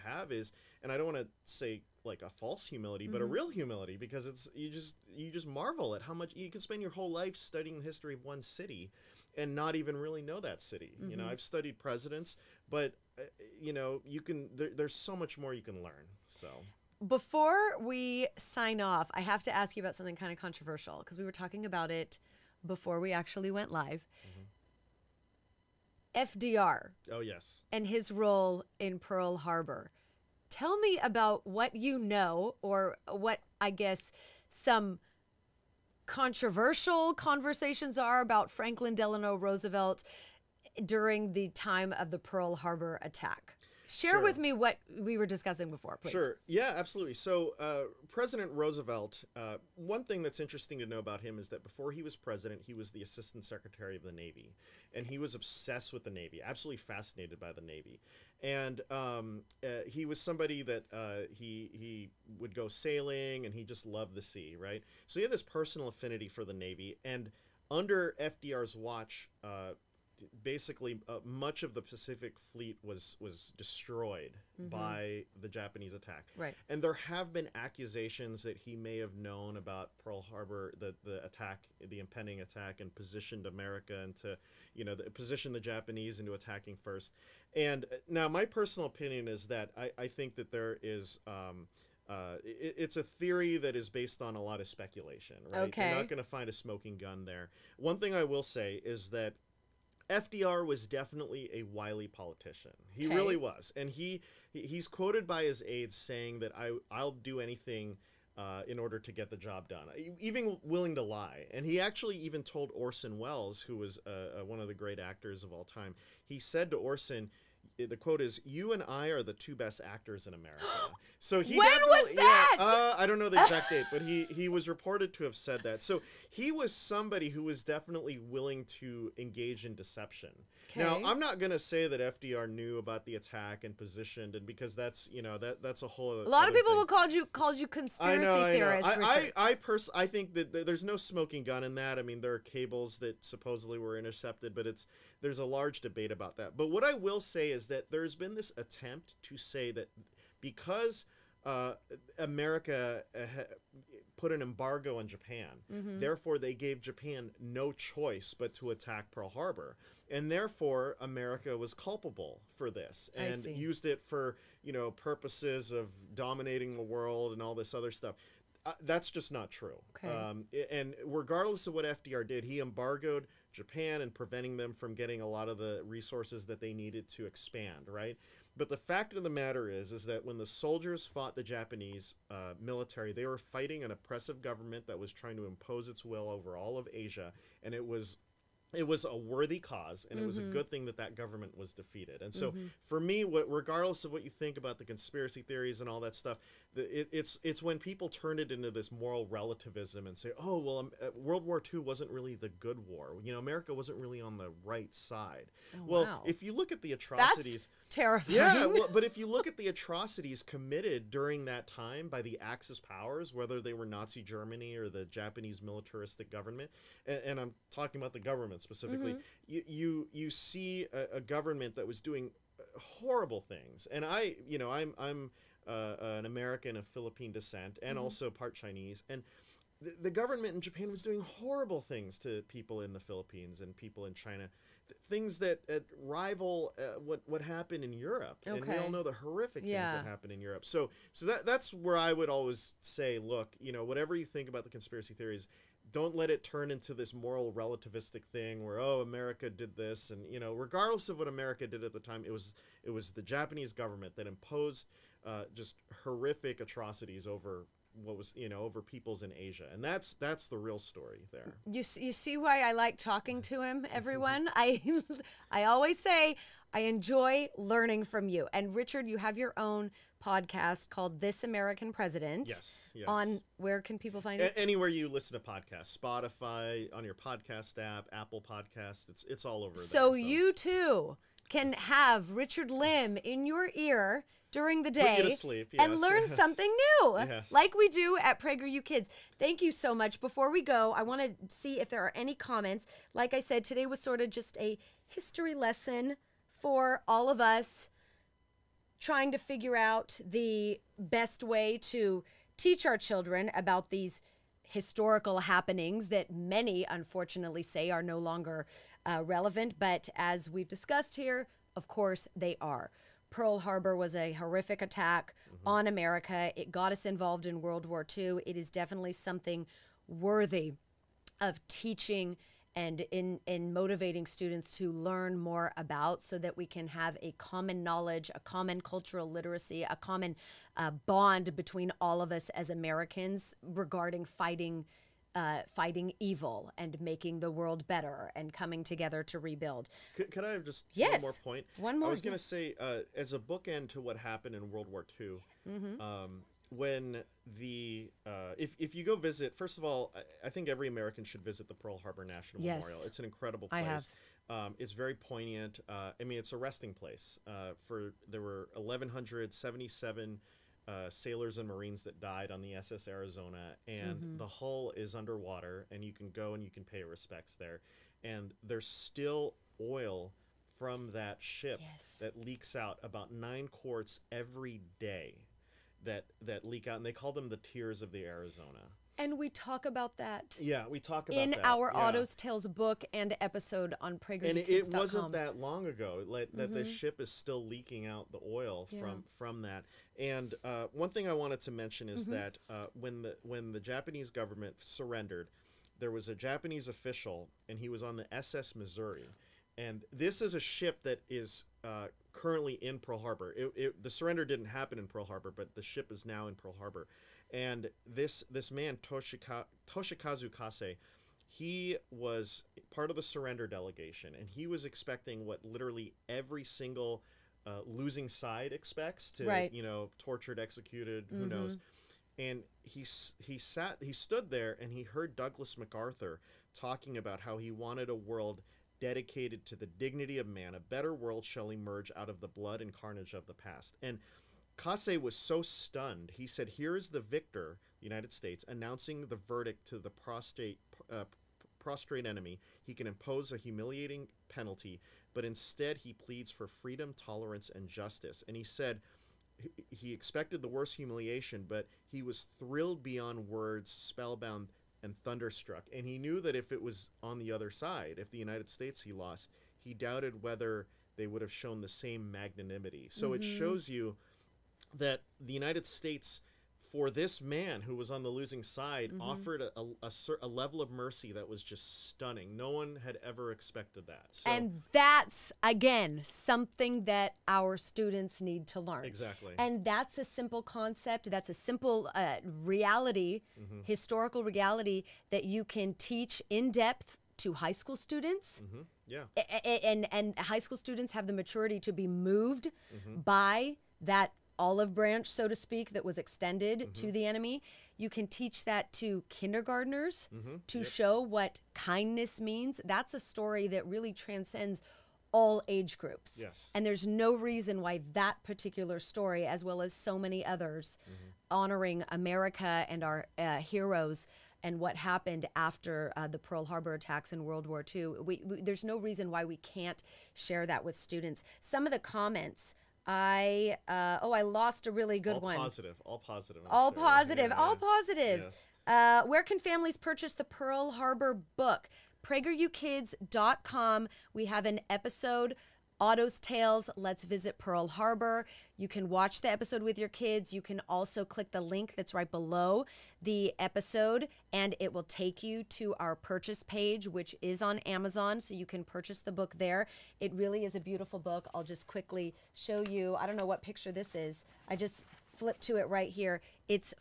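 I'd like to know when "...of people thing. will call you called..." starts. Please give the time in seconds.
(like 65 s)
136 s.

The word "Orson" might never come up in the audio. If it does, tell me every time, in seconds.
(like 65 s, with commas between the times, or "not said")
112 s, 116 s.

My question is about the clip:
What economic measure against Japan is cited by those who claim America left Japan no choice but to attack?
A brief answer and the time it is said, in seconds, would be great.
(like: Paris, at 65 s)
An embargo, at 154 s.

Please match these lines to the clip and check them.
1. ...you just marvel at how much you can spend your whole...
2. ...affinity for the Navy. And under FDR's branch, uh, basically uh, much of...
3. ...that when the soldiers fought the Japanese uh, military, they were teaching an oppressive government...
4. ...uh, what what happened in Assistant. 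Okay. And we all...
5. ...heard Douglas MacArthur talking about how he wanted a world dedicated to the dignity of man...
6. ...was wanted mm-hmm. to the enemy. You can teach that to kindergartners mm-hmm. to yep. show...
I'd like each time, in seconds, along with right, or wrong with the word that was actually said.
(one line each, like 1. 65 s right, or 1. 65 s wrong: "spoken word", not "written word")
1. 5 s right
2. 65 s wrong: "watch", not "branch"
3. 180 s wrong: "fighting", not "teaching"
4. 236 s wrong: "Europe", not "Assistant"
5. 425 s right
6. 496 s wrong: "extended", not "wanted".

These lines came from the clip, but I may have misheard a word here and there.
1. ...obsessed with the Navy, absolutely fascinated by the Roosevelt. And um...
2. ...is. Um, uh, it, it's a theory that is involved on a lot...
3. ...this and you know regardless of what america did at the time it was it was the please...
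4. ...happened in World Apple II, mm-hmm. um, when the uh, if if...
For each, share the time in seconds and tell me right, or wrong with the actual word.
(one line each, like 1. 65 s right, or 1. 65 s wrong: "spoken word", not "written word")
1. 55 s wrong: "Navy", not "Roosevelt"
2. 90 s wrong: "based", not "involved"
3. 249 s wrong: "japanese", not "please"
4. 344 s wrong: "War", not "Apple".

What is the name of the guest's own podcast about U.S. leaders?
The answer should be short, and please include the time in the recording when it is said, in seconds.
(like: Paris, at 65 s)
This American President, at 271 s.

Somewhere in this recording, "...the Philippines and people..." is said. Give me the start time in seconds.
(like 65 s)
232 s.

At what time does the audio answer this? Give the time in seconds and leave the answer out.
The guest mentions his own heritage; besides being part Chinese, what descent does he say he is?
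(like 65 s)
226 s.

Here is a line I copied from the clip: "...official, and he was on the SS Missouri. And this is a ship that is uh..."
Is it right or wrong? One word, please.
right.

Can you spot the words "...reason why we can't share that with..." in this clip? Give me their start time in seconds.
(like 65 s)
518 s.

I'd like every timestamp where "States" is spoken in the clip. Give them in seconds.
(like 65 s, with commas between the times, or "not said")
438 s, 458 s, 465 s.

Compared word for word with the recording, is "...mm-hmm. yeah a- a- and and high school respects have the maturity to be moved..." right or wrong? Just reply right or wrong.
wrong.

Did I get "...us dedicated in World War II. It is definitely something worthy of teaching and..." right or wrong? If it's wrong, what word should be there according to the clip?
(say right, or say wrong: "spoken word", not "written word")
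wrong: "involved", not "dedicated".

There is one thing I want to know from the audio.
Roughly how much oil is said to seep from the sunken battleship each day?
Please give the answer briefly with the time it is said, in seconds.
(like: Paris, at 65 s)
9 quarts, at 373 s.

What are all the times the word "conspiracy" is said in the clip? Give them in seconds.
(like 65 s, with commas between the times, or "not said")
137 s, 194 s, 244 s.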